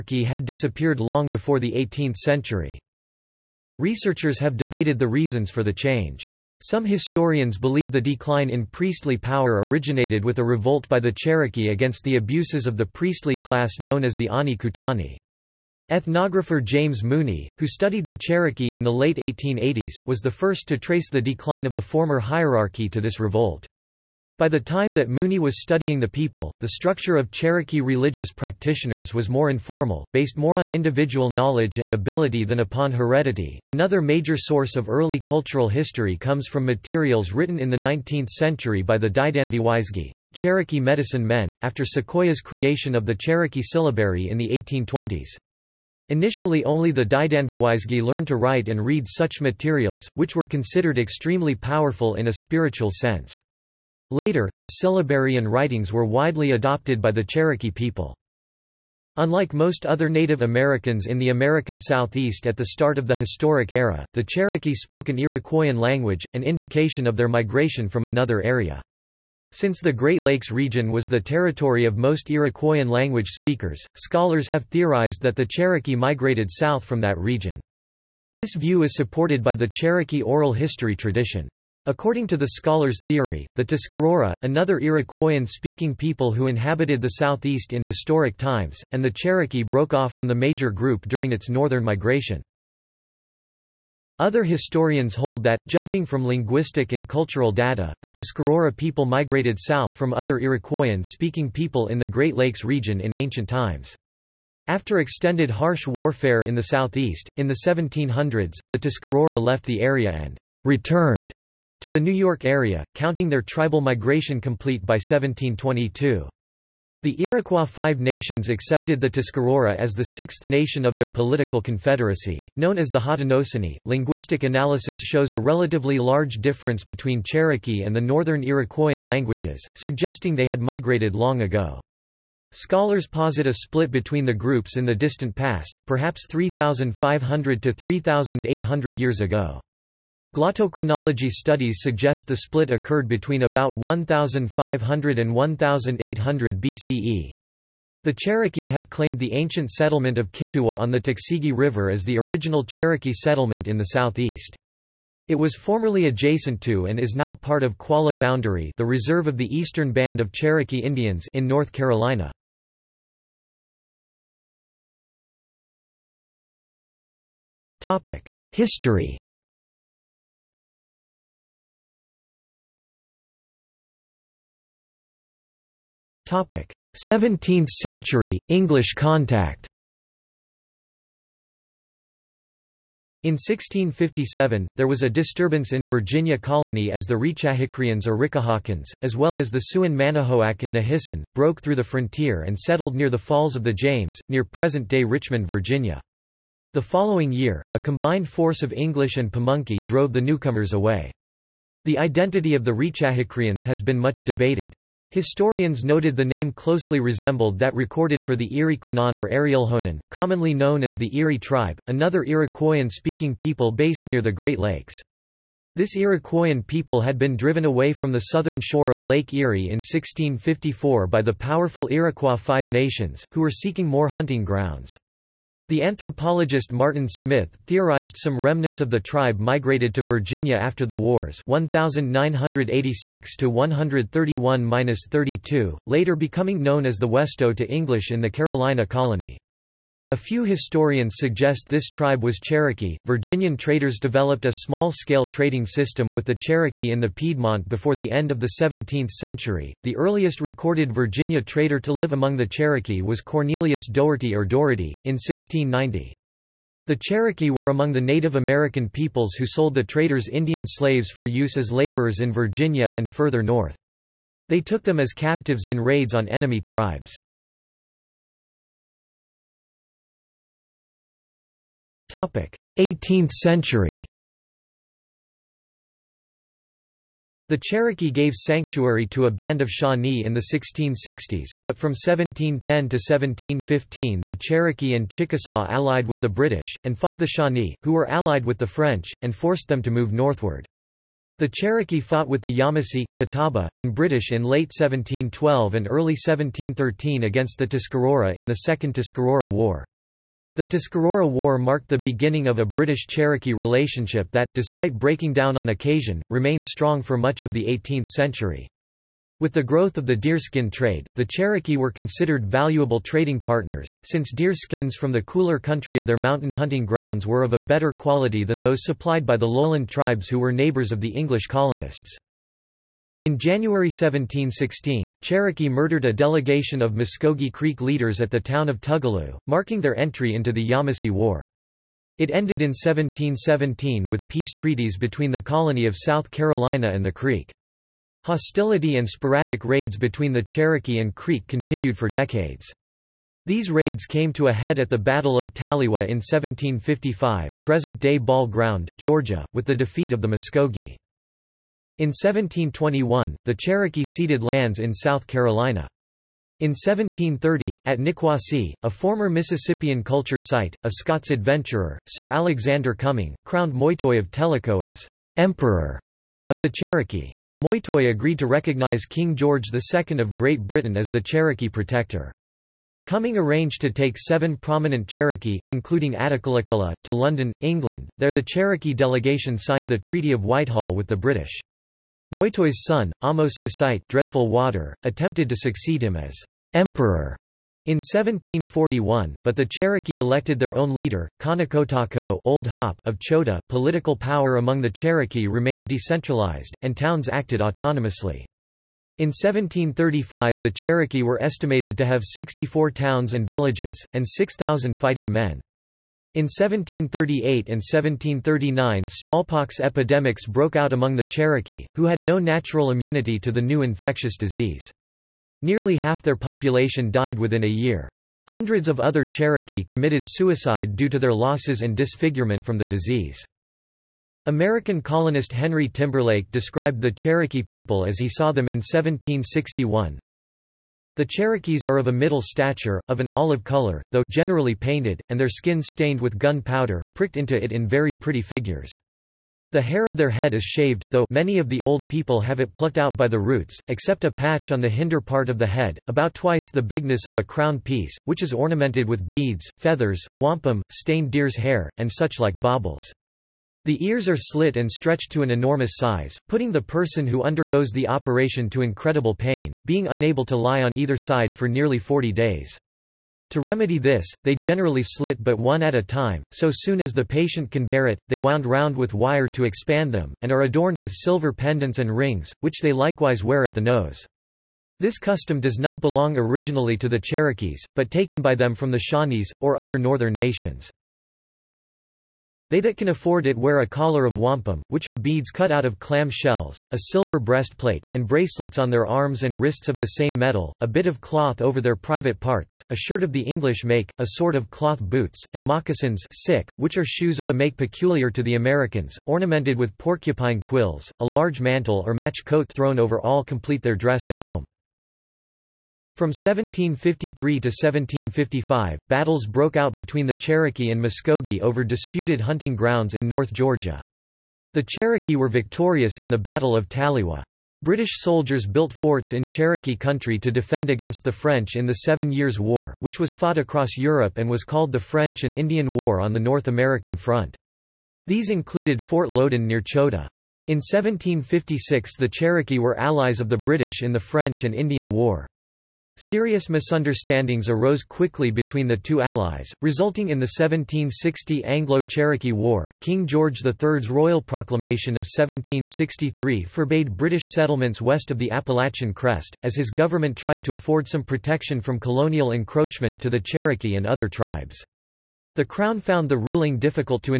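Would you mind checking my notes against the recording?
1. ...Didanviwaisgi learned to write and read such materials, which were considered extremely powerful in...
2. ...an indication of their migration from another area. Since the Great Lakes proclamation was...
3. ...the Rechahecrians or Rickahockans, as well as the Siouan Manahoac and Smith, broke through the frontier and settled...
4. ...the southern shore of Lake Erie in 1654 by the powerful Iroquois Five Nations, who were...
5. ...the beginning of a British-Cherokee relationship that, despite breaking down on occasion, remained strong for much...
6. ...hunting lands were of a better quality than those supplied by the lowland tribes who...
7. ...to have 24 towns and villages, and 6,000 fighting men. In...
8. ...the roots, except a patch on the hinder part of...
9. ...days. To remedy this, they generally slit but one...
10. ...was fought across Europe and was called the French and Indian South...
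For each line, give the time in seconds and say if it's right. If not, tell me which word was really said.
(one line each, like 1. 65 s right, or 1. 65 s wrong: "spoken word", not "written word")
1. 47 s right
2. 66 s wrong: "region", not "proclamation"
3. 187 s wrong: "Nahissan", not "Smith"
4. 218 s right
5. 301 s right
6. 316 s wrong: "grounds", not "lands"
7. 401 s wrong: "64", not "24"
8. 443 s right
9. 462 s right
10. 523 s wrong: "War", not "South".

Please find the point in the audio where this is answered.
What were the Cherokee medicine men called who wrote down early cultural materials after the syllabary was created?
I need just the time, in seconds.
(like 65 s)
39 s.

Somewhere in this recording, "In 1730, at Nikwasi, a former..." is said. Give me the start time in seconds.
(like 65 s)
356 s.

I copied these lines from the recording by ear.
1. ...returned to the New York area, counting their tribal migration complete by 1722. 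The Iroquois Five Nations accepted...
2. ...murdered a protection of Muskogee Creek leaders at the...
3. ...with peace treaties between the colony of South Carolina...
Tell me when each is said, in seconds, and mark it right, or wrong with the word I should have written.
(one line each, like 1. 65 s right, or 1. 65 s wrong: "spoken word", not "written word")
1. 110 s right
2. 325 s wrong: "delegation", not "protection"
3. 334 s right.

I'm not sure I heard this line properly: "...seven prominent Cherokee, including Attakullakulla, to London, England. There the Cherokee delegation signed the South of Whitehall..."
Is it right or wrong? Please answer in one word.
wrong.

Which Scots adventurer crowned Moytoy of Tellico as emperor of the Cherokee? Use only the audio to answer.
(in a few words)
Sir Alexander Cumming.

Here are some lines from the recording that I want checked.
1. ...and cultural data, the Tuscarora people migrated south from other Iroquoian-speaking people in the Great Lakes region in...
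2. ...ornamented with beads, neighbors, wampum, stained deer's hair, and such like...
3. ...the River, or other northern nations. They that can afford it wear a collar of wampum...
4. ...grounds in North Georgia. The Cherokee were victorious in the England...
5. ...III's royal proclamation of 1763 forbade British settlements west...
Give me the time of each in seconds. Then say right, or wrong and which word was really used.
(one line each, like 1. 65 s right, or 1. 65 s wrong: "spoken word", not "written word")
1. 96 s right
2. 448 s wrong: "feathers", not "neighbors"
3. 478 s wrong: "Shawnees", not "River"
4. 512 s wrong: "Battle", not "England"
5. 543 s right.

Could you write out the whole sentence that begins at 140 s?
Glottochronology studies suggest the split occurred between about 1500 and 1800 BCE.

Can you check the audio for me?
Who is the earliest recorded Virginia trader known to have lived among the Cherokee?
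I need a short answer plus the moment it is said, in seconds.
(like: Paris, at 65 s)
Cornelius Doherty, at 253 s.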